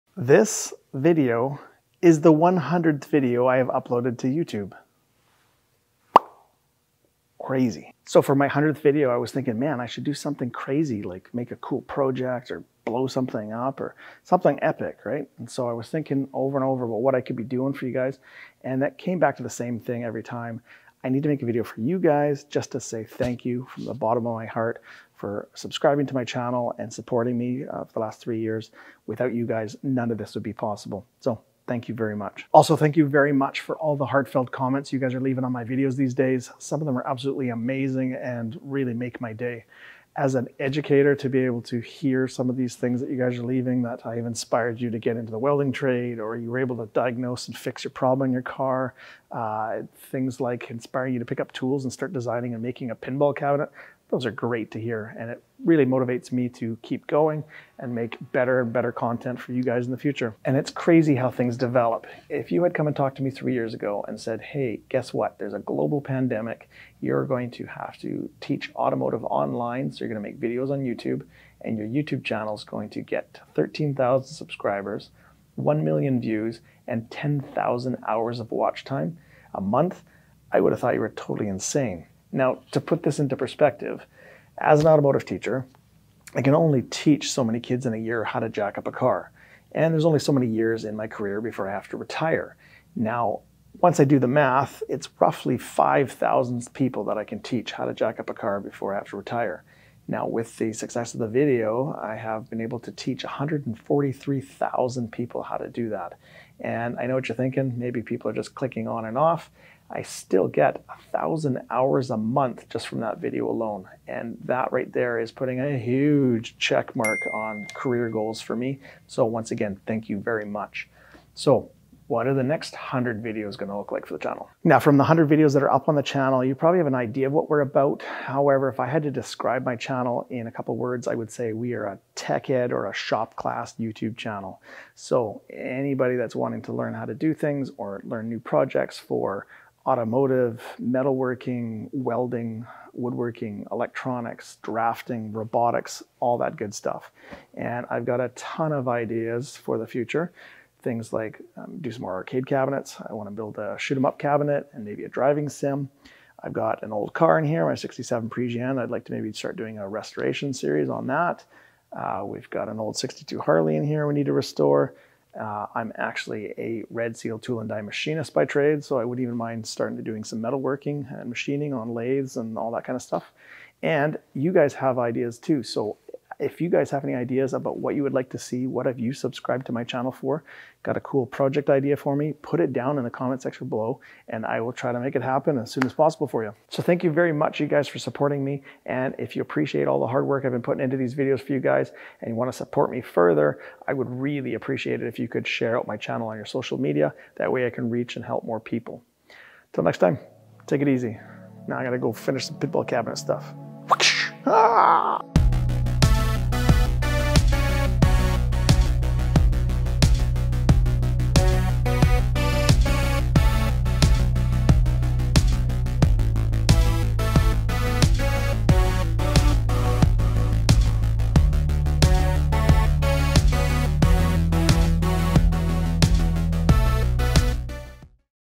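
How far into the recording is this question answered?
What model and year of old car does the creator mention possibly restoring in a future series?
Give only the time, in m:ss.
2:37.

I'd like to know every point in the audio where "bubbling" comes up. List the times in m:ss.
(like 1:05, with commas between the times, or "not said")
not said.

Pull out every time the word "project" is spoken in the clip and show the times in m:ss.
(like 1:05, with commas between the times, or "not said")
0:11, 2:18, 3:01.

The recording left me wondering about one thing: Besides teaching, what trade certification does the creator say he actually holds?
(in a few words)
Red Seal tool and die machinist.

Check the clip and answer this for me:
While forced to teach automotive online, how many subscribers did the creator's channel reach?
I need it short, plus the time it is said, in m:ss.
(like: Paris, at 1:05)
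13,000, at 1:13.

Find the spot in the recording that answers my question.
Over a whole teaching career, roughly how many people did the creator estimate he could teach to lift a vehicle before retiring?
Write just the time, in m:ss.
1:35.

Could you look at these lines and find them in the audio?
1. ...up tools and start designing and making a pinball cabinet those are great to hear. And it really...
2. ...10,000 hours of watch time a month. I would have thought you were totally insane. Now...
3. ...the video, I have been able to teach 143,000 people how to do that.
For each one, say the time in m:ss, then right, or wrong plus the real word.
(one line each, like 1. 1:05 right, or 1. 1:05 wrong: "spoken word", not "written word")
1. 0:51 right
2. 1:17 right
3. 1:41 right.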